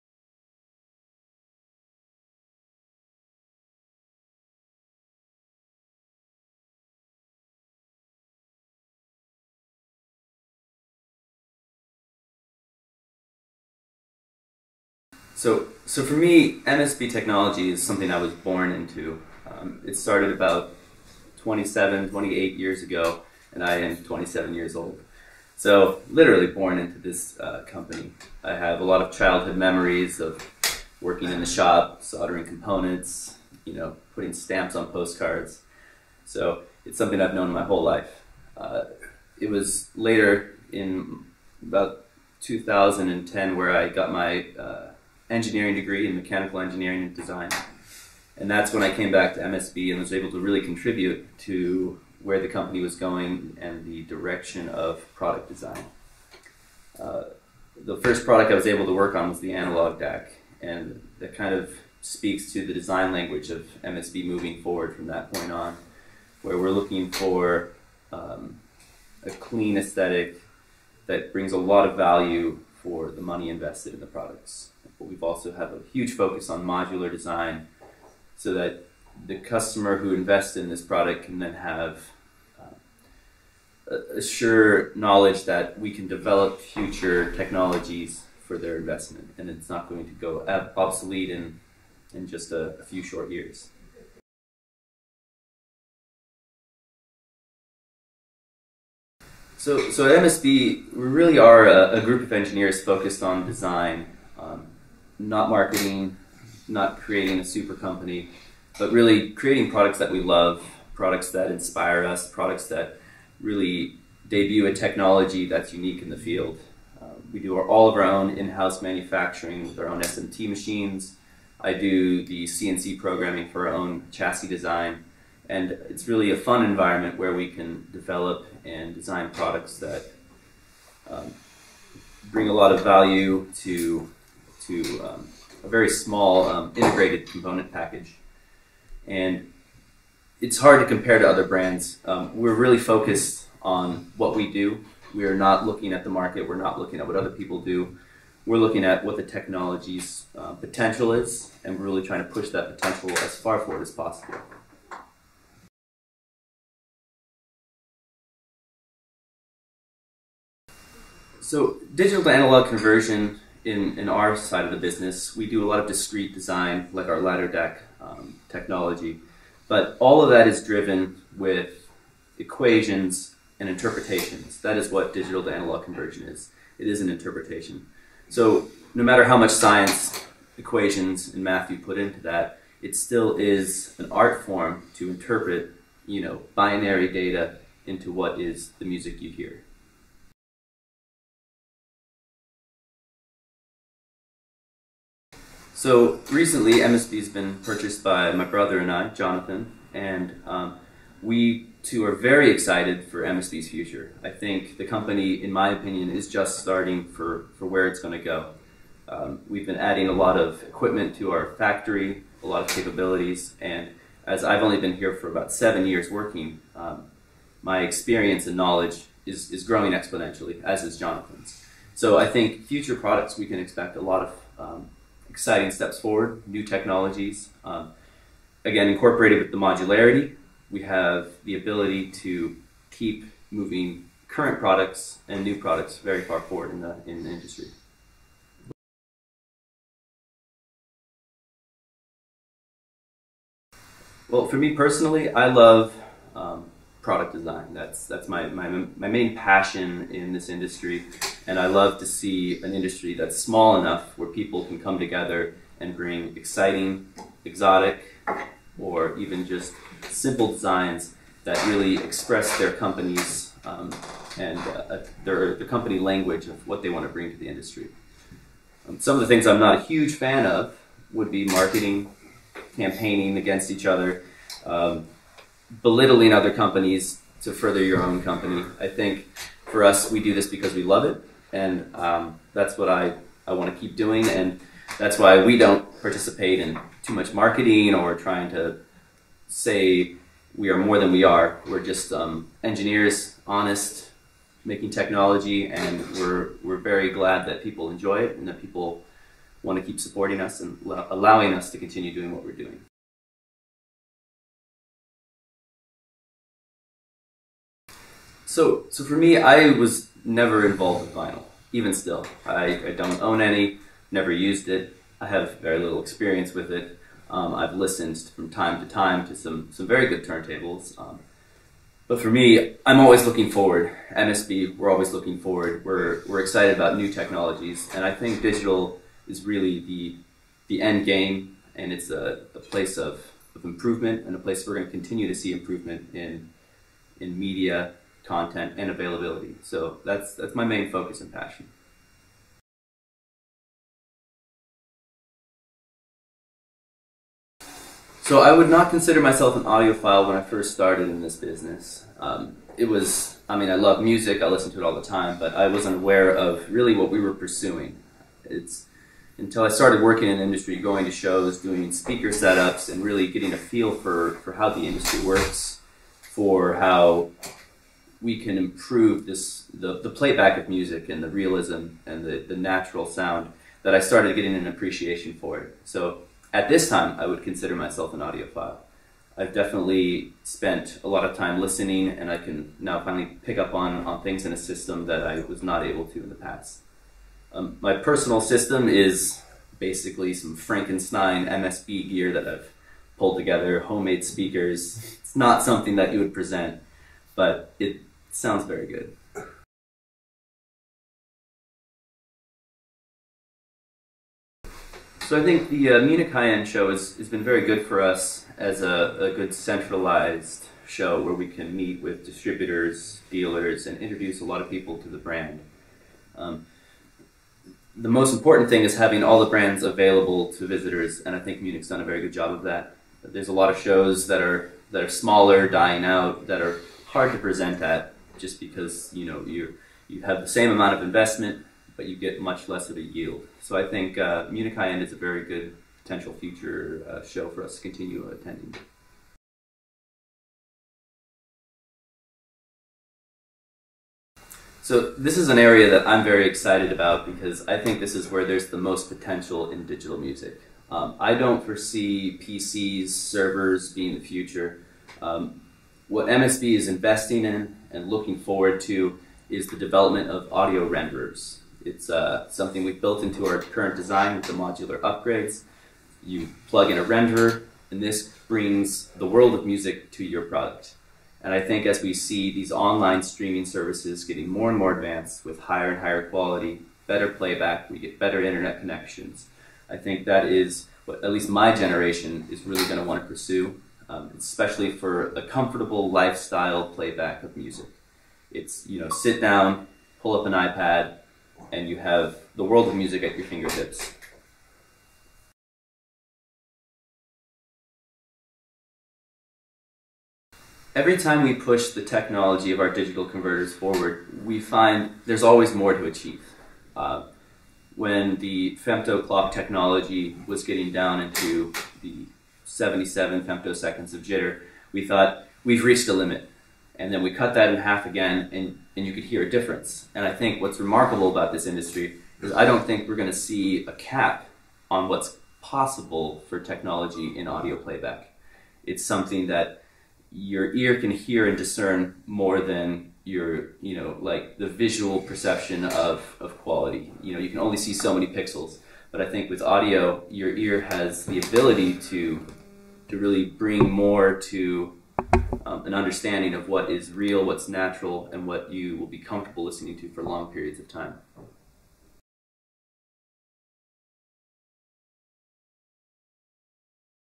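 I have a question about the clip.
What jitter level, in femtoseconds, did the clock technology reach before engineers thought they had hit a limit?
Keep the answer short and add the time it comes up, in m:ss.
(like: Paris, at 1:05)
77 femtoseconds, at 8:32.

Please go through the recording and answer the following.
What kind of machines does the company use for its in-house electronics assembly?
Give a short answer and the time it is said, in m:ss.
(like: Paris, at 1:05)
SMT machines, at 2:00.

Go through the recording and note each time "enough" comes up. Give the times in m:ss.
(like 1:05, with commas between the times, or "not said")
4:13.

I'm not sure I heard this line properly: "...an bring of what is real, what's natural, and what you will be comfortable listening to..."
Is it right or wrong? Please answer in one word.
wrong.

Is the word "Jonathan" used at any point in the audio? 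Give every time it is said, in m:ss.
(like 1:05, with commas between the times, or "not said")
3:19, 3:40.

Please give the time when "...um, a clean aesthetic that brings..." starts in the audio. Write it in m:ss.
1:08.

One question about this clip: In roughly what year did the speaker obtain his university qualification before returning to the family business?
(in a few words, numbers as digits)
2010.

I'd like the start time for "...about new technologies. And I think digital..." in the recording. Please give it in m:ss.
5:26.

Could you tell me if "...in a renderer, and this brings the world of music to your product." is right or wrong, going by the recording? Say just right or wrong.
right.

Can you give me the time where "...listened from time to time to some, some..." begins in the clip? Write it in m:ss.
5:17.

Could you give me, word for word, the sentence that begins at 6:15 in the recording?
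So at this time, I would consider myself an audiophile.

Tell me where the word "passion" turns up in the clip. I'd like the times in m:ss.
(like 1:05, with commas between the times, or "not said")
4:09, 5:41.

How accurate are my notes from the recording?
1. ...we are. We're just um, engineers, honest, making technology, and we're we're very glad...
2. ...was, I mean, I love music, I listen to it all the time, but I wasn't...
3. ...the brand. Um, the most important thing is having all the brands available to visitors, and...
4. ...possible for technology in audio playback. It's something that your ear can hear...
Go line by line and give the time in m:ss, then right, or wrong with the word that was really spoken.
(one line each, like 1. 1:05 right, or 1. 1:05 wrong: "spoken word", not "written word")
1. 4:51 right
2. 5:52 right
3. 6:55 right
4. 8:45 right.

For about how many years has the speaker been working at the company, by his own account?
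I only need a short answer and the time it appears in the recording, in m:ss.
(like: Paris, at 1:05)
7, at 3:35.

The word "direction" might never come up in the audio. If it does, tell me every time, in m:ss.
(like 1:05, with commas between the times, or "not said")
0:54.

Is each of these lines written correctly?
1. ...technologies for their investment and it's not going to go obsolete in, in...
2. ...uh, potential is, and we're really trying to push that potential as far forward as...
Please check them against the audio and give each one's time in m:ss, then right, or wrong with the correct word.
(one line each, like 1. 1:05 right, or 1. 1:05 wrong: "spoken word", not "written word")
1. 1:27 right
2. 2:30 right.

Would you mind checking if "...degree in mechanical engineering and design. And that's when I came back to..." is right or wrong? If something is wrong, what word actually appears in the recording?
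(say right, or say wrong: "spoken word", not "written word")
right.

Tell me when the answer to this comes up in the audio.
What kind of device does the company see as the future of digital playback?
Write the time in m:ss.
7:40.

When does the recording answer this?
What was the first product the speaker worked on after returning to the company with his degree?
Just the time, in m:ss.
0:59.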